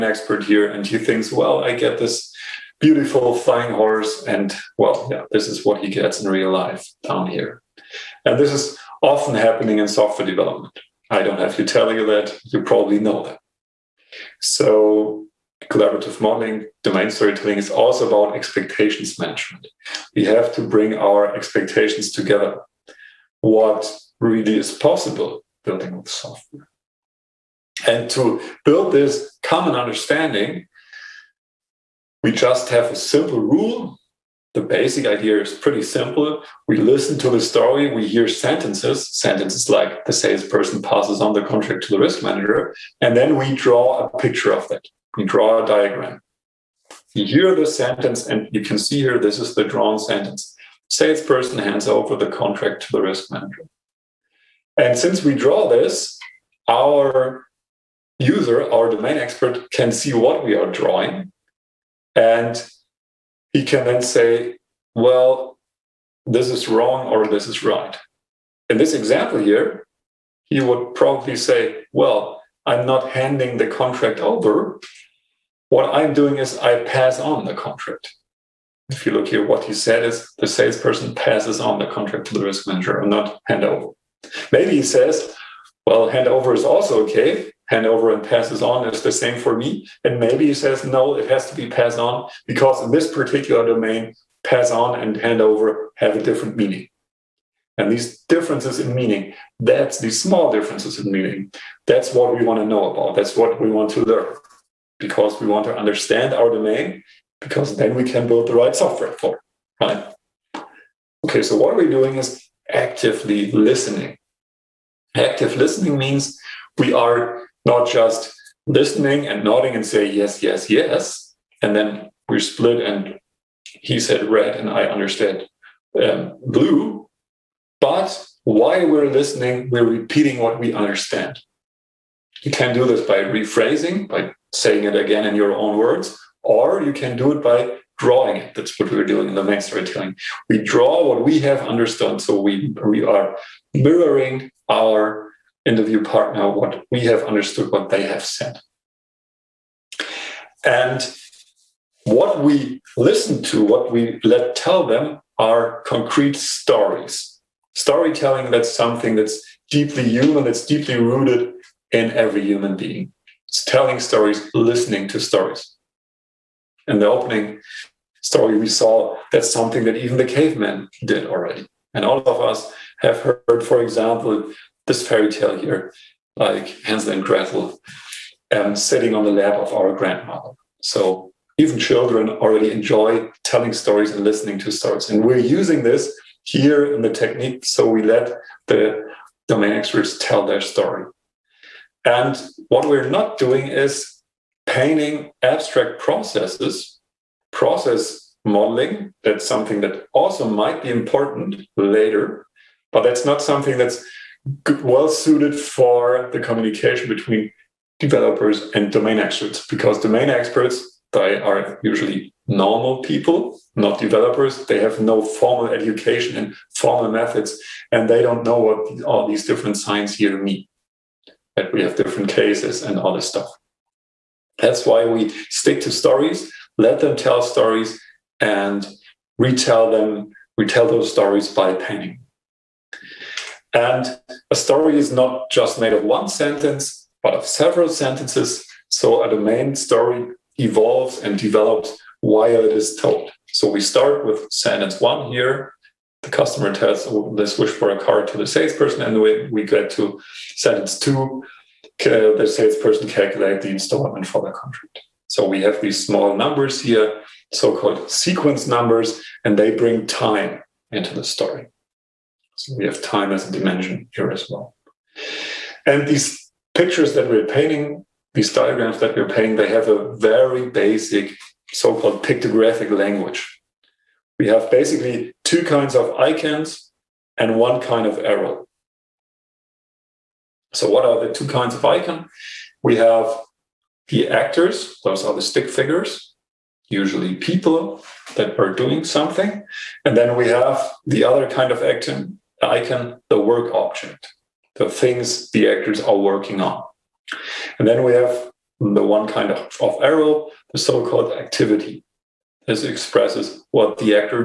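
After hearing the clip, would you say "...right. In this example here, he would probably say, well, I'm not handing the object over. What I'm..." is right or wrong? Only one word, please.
wrong.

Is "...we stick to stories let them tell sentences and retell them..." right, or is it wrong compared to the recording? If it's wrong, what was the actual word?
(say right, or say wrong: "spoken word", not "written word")
wrong: "stories", not "sentences".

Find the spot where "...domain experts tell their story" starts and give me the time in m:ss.
3:09.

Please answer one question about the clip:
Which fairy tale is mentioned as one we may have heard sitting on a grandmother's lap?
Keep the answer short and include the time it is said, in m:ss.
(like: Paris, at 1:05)
Hansel and Gretel, at 2:56.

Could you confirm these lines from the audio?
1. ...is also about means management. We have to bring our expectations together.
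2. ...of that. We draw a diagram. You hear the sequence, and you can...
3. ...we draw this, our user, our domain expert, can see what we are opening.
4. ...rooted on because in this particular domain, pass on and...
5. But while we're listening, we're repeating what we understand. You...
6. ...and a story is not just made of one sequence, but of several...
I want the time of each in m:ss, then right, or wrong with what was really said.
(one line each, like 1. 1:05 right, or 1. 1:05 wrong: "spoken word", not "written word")
1. 0:17 wrong: "expectations", not "means"
2. 0:44 wrong: "sentence", not "sequence"
3. 0:55 wrong: "drawing", not "opening"
4. 1:31 wrong: "passed", not "rooted"
5. 2:07 right
6. 3:53 wrong: "sentence", not "sequence".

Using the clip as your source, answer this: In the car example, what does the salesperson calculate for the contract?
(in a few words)
The installment.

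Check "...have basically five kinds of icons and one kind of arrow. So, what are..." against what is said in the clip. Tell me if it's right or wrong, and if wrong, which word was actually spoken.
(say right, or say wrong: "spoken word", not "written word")
wrong: "two", not "five".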